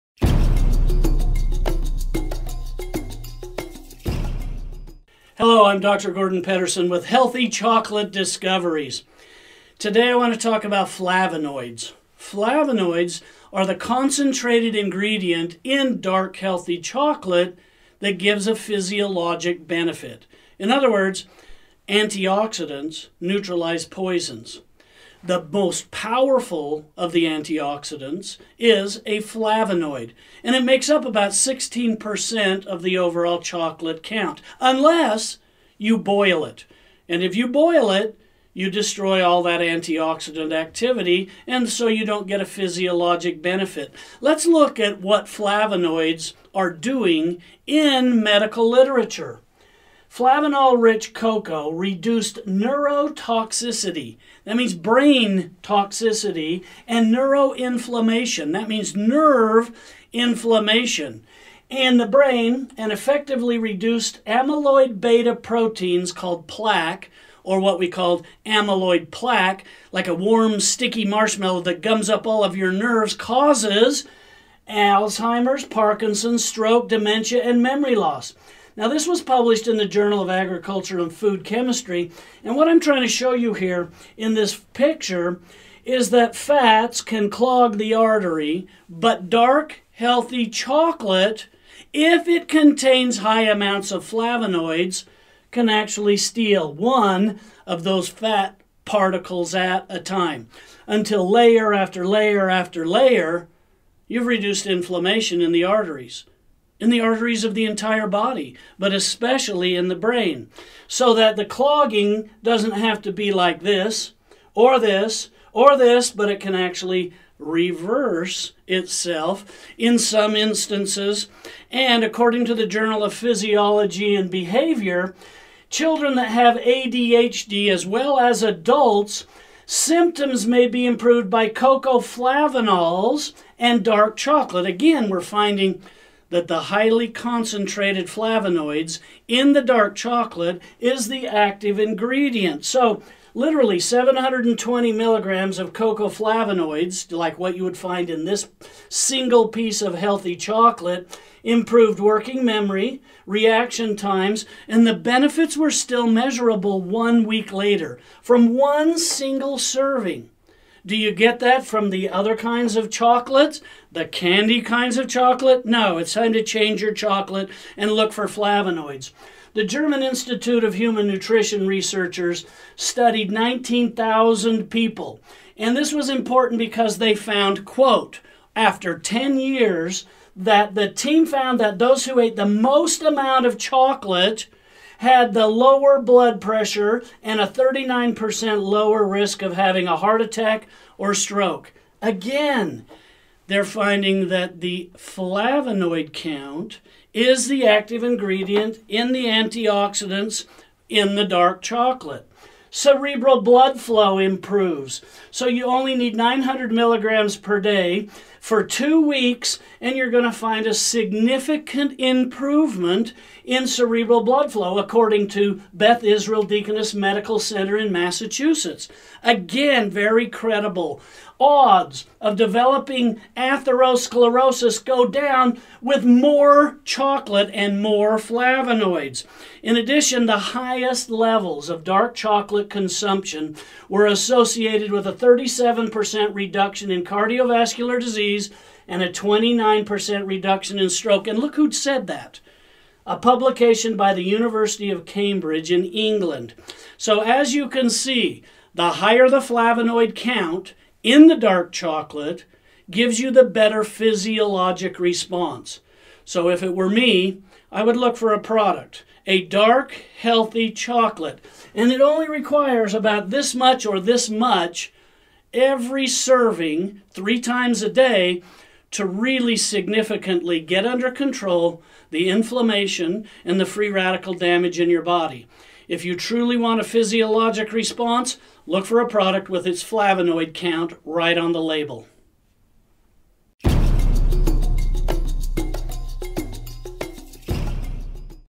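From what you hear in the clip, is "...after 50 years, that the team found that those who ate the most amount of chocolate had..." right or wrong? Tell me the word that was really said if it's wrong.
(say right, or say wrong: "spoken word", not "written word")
wrong: "10", not "50".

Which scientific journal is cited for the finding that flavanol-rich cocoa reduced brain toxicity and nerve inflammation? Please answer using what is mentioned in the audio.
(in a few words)
Journal of Agriculture and Food Chemistry.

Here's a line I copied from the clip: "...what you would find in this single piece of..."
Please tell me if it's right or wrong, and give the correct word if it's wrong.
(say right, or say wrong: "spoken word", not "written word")
right.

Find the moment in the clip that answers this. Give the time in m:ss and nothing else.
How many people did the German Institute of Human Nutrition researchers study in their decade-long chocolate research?
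2:53.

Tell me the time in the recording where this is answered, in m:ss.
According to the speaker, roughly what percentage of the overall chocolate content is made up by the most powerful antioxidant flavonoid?
0:31.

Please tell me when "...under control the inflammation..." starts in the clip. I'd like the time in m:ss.
4:30.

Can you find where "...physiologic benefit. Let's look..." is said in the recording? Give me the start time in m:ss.
0:42.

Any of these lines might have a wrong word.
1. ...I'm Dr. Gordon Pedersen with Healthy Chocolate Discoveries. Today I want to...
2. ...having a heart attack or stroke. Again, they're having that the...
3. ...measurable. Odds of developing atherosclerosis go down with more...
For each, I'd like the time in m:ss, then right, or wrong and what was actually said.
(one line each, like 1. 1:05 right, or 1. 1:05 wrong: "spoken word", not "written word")
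1. 0:05 right
2. 3:09 wrong: "finding", not "having"
3. 3:40 wrong: "credible", not "measurable".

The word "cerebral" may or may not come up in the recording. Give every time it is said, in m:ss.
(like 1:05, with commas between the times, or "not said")
3:22, 3:33.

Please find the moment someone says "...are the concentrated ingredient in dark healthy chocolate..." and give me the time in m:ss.
0:13.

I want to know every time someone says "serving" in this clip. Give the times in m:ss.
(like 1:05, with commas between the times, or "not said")
2:39, 4:26.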